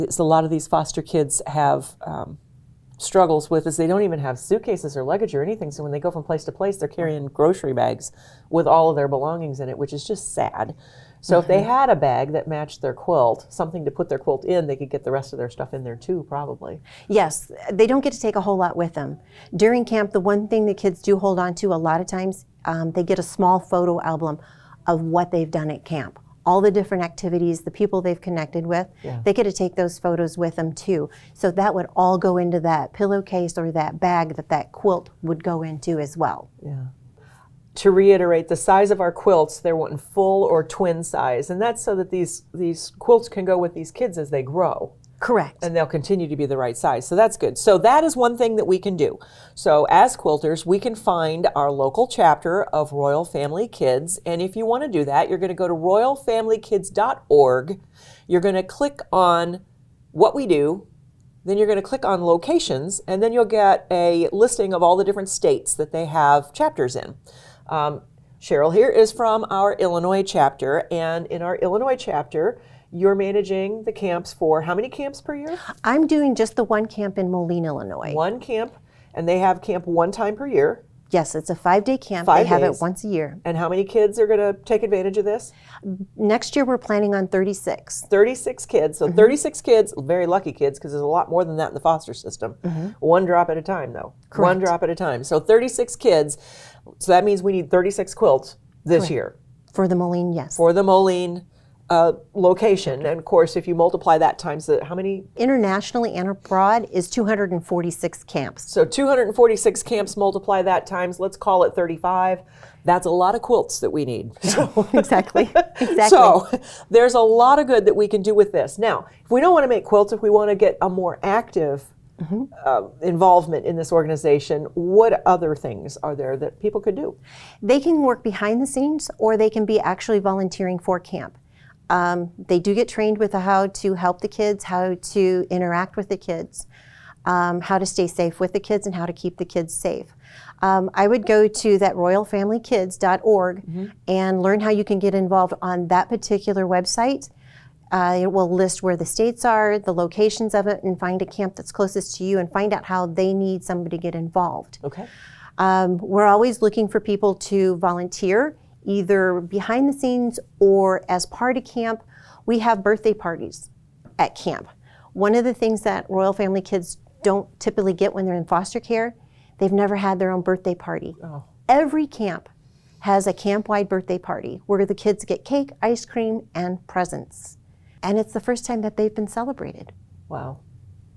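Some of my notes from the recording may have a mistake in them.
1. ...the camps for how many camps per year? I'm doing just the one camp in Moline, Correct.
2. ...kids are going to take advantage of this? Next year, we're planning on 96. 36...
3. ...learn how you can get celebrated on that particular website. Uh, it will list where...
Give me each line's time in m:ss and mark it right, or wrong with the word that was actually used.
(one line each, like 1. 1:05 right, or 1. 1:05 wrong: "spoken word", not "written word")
1. 1:13 wrong: "Illinois", not "Correct"
2. 1:23 wrong: "36", not "96"
3. 2:24 wrong: "involved", not "celebrated".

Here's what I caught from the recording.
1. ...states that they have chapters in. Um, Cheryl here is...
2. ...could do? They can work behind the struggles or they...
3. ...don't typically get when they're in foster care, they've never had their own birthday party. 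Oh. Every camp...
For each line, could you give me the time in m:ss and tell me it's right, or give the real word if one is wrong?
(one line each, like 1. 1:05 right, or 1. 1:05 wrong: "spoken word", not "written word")
1. 1:05 right
2. 2:06 wrong: "scenes", not "struggles"
3. 2:47 right.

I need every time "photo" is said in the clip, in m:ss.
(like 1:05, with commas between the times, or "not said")
0:23, 0:29.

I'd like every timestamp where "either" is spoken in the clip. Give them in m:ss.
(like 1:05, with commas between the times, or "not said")
2:38.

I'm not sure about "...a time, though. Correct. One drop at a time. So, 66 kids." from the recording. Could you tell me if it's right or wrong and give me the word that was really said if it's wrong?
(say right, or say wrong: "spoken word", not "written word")
wrong: "36", not "66".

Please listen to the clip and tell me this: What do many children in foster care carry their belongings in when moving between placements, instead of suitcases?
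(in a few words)
Grocery bags.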